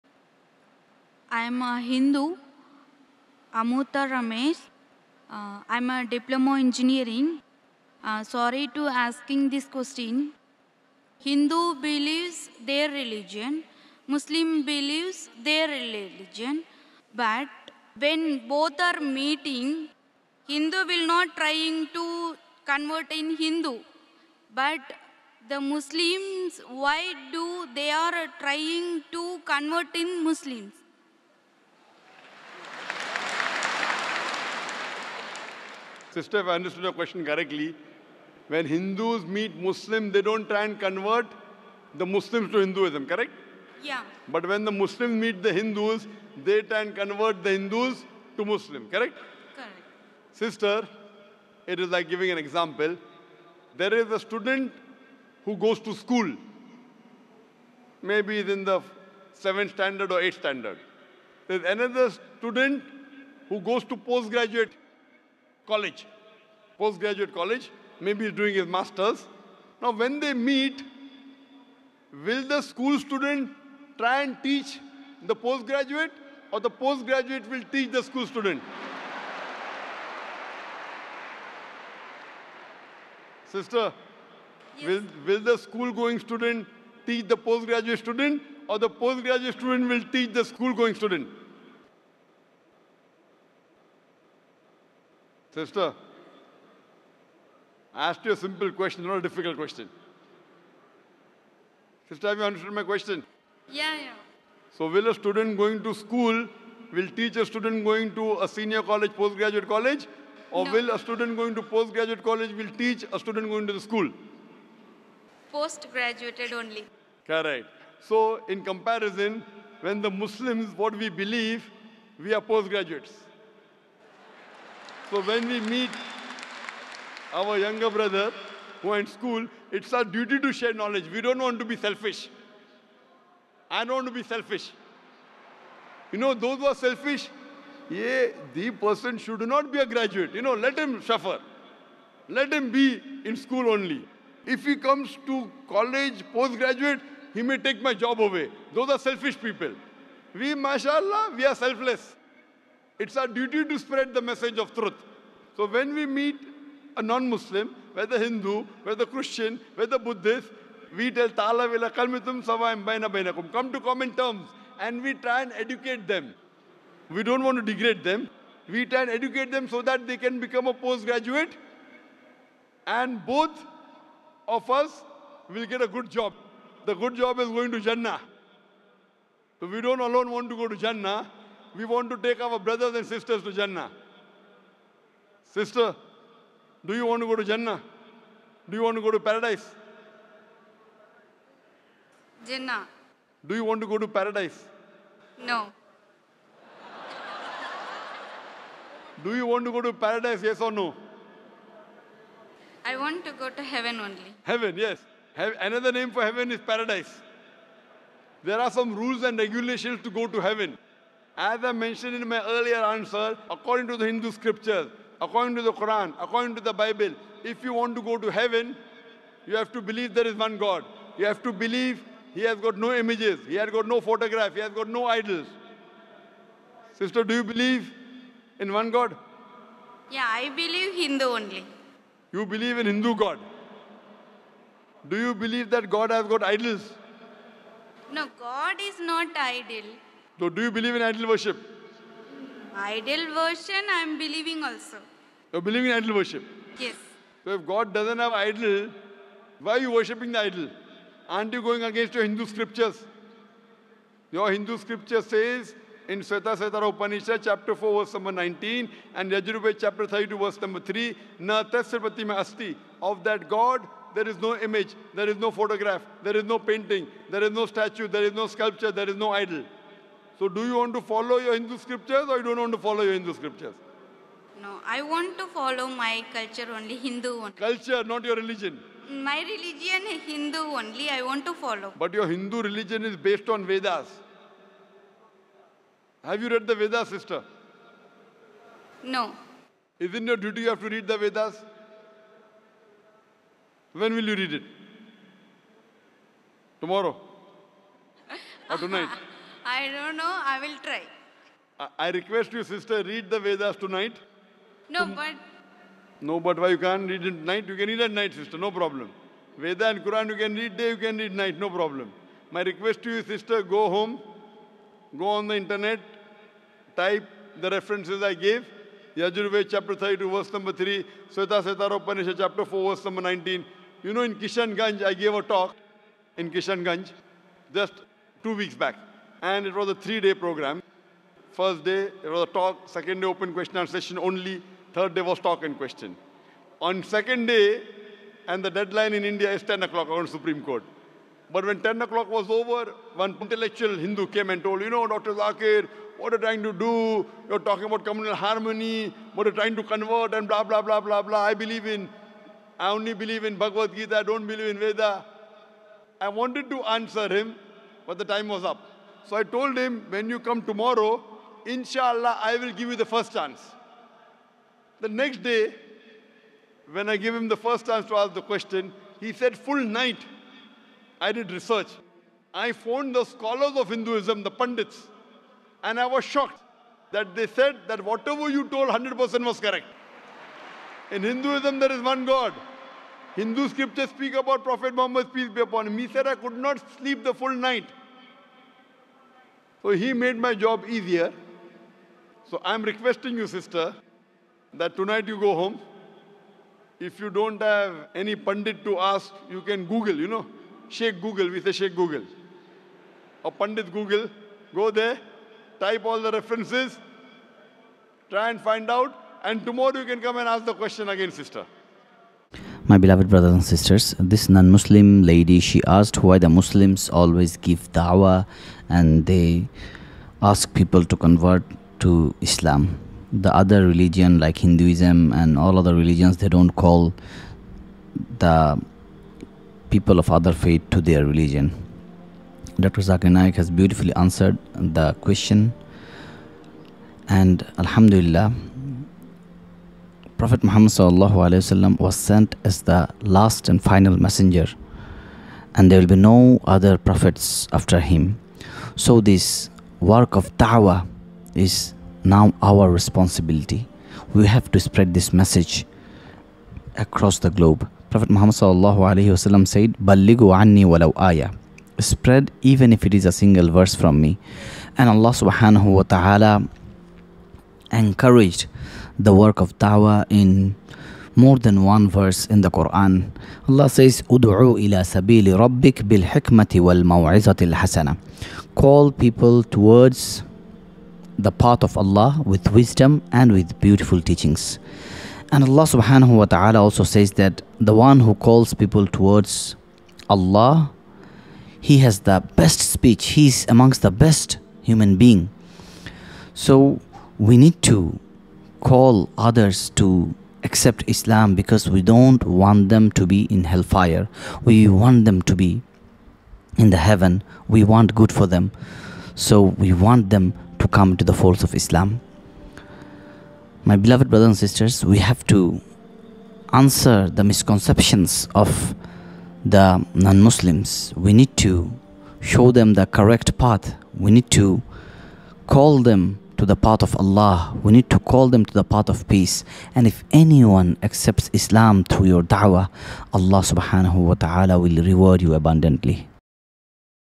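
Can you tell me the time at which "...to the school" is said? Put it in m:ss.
1:53.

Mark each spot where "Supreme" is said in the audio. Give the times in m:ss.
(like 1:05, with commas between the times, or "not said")
5:40.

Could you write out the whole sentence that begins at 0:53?
There is a student who goes to school.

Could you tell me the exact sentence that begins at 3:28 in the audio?
There are some rules and regulations to go to heaven.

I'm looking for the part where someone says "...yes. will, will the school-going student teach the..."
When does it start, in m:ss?
1:24.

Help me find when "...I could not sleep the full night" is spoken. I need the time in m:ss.
6:26.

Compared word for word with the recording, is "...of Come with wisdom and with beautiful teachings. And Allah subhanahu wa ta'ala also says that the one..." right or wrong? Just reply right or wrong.
wrong.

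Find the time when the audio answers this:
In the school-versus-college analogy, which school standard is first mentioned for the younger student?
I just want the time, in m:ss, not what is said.
0:59.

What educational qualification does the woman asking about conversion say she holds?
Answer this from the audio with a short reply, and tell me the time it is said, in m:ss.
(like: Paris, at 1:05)
Diploma engineering, at 0:06.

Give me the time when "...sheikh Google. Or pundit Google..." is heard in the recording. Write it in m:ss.
6:41.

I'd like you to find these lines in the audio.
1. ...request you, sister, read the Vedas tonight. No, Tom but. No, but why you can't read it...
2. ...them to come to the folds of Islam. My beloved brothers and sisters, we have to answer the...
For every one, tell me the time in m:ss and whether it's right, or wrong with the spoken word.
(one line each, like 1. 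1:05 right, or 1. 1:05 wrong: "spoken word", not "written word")
1. 5:02 right
2. 8:30 right.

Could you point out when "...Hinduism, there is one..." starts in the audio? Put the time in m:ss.
6:21.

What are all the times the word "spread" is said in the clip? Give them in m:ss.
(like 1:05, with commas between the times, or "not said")
2:33, 7:34, 7:41.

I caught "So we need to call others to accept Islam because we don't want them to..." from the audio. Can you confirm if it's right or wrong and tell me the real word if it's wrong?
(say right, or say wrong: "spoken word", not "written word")
right.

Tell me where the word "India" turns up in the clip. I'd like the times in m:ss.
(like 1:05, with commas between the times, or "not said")
5:39.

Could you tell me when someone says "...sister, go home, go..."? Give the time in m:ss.
5:13.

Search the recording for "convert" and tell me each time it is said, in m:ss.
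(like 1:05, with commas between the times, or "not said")
0:22, 0:29, 0:40, 0:46, 5:49, 7:01.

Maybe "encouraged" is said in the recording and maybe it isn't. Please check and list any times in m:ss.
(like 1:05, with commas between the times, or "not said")
7:47.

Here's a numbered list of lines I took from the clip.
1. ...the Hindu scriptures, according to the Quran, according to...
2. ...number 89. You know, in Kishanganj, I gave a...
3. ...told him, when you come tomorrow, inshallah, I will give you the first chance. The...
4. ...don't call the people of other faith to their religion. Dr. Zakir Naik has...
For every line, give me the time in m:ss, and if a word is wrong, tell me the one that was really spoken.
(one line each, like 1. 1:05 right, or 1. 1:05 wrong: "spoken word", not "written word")
1. 3:33 right
2. 5:23 wrong: "19", not "89"
3. 5:59 right
4. 7:06 right.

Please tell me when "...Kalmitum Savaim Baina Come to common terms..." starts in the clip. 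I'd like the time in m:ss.
2:41.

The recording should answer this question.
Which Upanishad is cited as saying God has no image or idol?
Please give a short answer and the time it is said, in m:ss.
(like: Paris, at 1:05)
Svetasvatara Upanishad, at 4:16.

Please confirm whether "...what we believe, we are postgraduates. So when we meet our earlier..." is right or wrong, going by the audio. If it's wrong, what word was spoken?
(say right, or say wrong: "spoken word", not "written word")
wrong: "younger", not "earlier".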